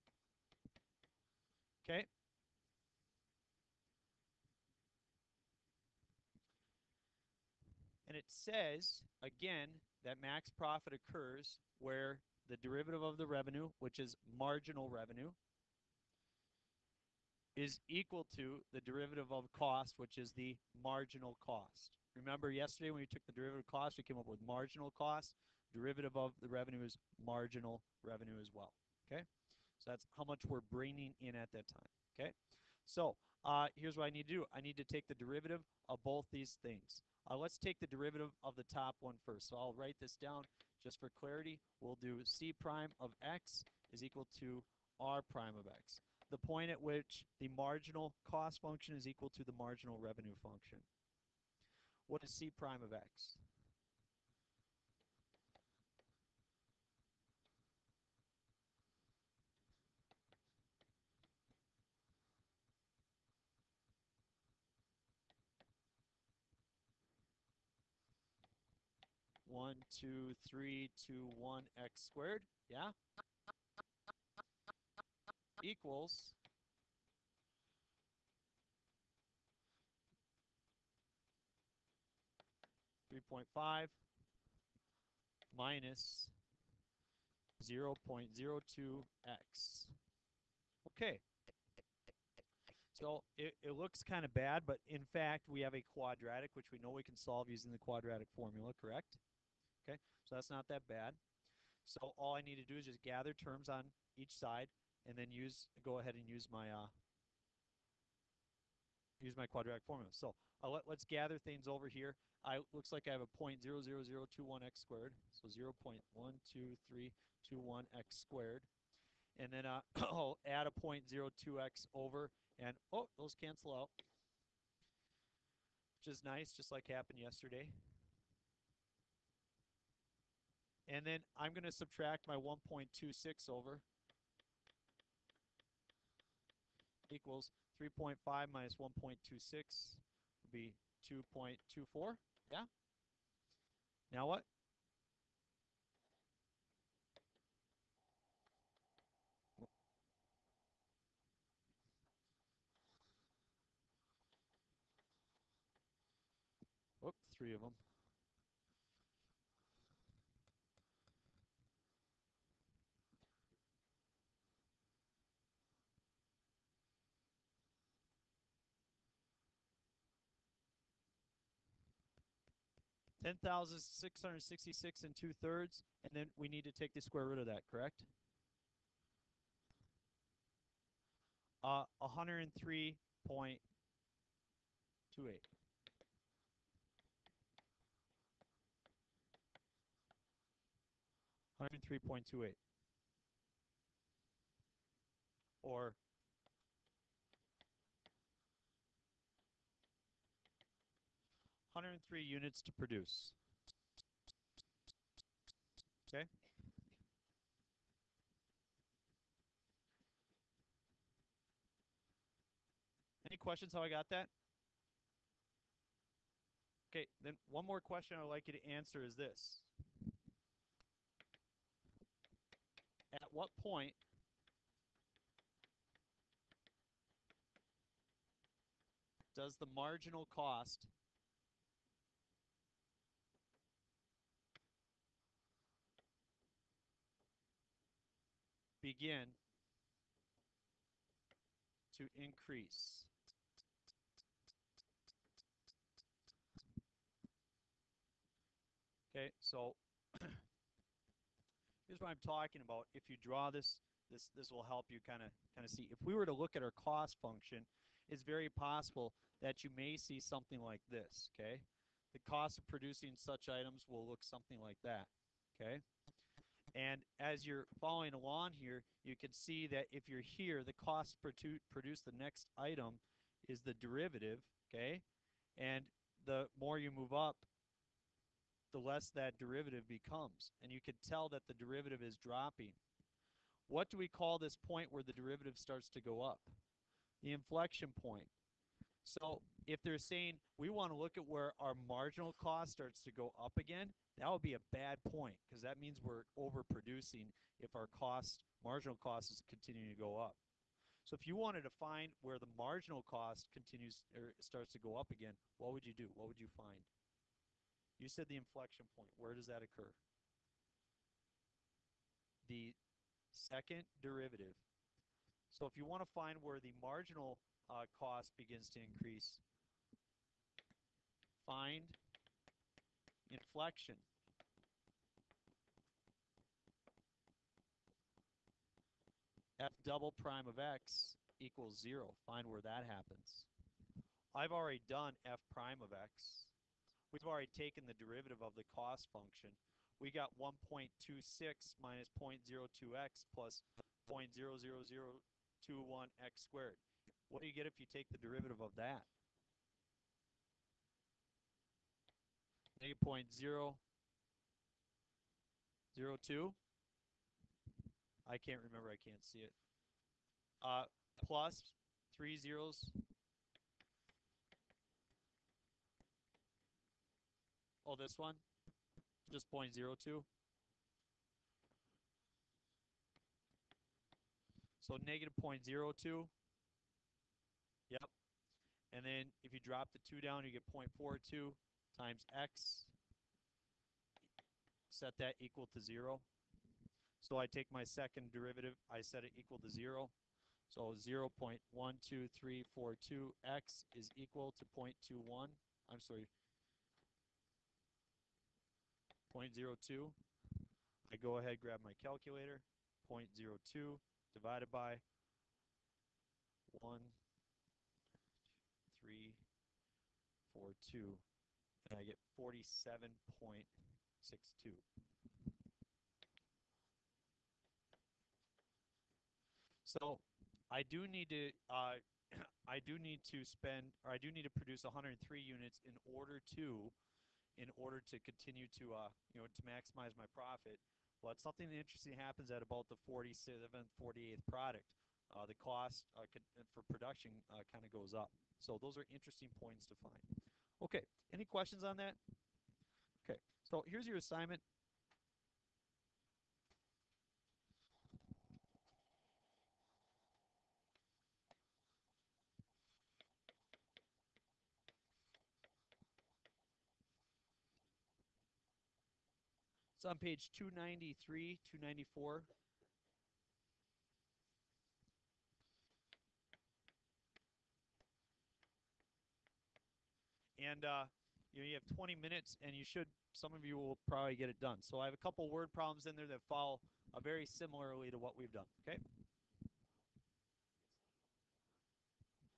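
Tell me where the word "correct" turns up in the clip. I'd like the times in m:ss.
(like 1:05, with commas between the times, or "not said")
1:38, 2:57.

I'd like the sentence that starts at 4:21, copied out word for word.
Okay, the cost of producing such items will look something like that.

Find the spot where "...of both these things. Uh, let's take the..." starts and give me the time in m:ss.
0:35.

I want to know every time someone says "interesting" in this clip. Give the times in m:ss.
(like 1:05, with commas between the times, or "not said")
7:11, 7:19.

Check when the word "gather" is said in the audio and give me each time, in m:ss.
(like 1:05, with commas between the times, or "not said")
1:43, 1:51.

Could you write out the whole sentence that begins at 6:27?
So I take my second derivative, I set it equal to 0.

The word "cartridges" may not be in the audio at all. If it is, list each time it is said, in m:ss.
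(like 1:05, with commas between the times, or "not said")
not said.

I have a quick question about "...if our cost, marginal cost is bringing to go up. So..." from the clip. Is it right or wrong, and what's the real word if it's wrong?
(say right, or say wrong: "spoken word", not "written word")
wrong: "continuing", not "bringing".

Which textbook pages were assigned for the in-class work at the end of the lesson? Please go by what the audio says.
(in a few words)
293, 294.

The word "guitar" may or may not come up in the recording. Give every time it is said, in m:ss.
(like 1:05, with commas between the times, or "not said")
not said.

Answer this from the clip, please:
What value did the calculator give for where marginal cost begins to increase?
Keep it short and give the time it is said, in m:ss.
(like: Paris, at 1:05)
47.62, at 6:52.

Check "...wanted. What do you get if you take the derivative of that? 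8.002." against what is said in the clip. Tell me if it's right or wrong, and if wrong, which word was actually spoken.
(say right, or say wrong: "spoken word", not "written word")
wrong: "squared", not "wanted".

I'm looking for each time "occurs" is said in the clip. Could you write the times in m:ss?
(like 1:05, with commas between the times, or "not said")
0:10, 5:09.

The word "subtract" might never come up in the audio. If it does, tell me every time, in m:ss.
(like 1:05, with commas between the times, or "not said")
2:11.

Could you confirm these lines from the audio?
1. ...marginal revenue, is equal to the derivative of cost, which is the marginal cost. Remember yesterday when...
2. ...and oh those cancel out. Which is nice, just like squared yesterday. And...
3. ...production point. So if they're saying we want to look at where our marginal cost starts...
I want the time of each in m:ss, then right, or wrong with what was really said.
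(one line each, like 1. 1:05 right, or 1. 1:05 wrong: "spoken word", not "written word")
1. 0:14 right
2. 2:02 wrong: "happened", not "squared"
3. 4:47 wrong: "inflection", not "production".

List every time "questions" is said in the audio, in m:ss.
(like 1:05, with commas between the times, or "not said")
3:33, 3:37, 7:21.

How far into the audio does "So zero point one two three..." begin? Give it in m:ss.
1:55.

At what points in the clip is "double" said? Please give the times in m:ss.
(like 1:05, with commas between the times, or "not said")
5:29.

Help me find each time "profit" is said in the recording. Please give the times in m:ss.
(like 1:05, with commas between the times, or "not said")
0:10, 7:10.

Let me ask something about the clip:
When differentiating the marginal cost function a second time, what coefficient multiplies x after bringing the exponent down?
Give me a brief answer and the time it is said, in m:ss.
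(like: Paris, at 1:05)
0.42, at 6:20.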